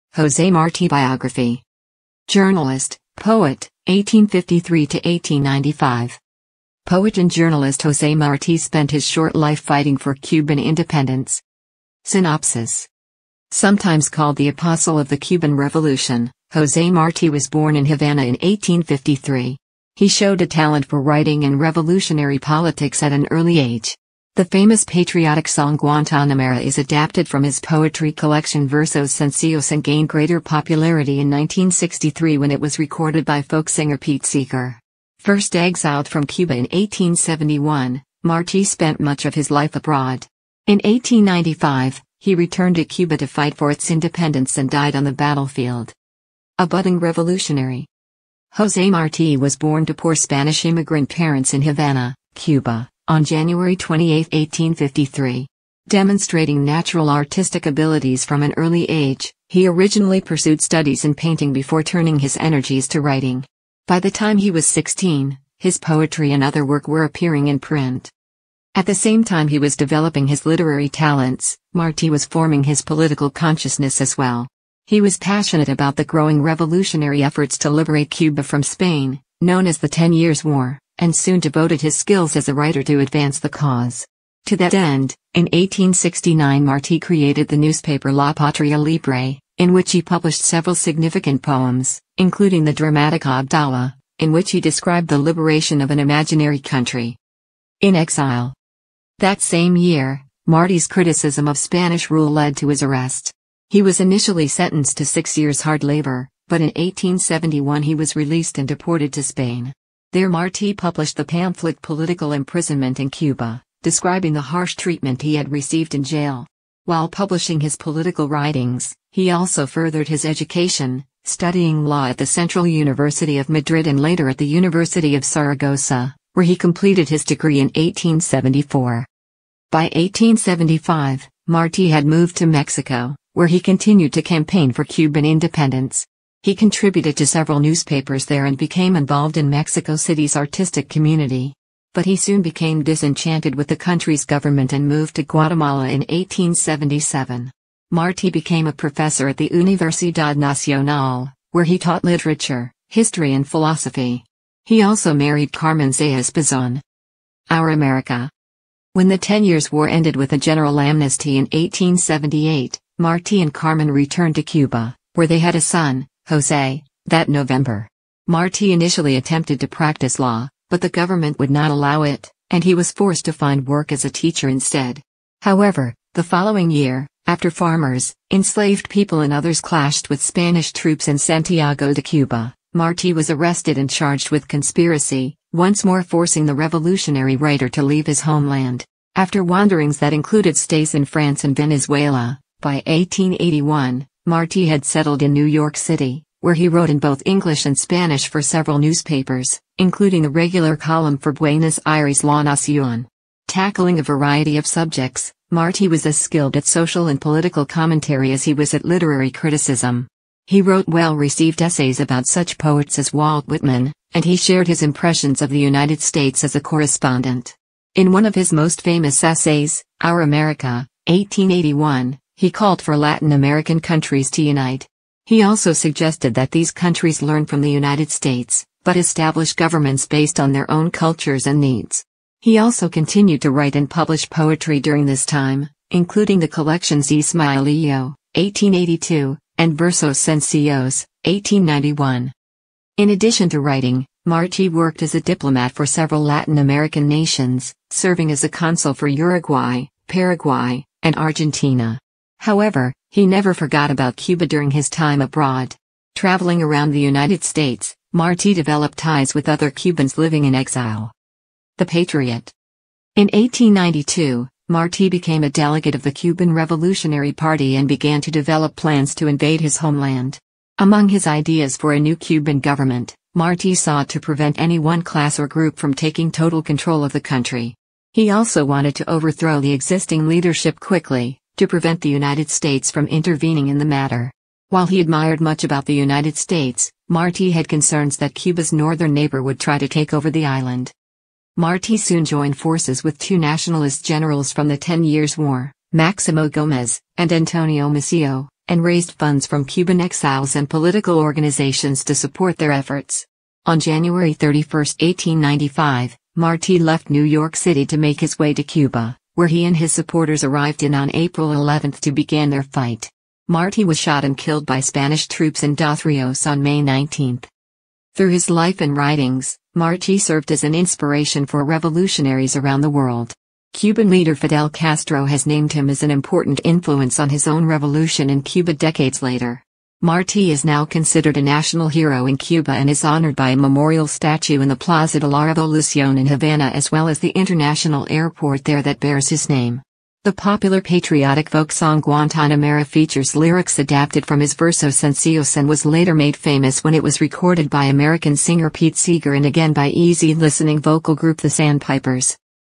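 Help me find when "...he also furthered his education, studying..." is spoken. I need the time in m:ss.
1:59.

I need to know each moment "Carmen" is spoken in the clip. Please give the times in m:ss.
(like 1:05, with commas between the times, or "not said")
2:35, 2:43.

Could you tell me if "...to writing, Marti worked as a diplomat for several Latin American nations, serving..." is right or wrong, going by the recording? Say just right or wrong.
right.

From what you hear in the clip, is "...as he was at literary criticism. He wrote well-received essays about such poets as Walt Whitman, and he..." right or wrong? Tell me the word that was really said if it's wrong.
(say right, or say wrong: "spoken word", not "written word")
right.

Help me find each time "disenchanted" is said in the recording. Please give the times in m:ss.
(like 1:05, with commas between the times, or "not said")
2:22.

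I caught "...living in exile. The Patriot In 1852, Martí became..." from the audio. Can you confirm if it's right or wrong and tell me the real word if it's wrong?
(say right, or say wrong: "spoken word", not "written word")
wrong: "1892", not "1852".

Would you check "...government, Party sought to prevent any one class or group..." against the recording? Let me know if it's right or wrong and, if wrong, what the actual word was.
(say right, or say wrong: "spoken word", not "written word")
wrong: "Martí", not "Party".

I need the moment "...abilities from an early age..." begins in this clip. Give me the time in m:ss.
0:57.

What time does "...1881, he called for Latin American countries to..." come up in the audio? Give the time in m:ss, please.
3:41.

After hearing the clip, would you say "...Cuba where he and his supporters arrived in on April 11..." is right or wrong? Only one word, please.
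right.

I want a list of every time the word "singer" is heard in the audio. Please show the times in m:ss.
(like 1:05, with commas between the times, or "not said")
0:33, 5:48.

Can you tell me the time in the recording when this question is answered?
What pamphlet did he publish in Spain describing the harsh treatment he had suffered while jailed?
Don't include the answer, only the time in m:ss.
1:51.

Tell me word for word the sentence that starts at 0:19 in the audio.
He showed a talent for writing and revolutionary politics at an early age.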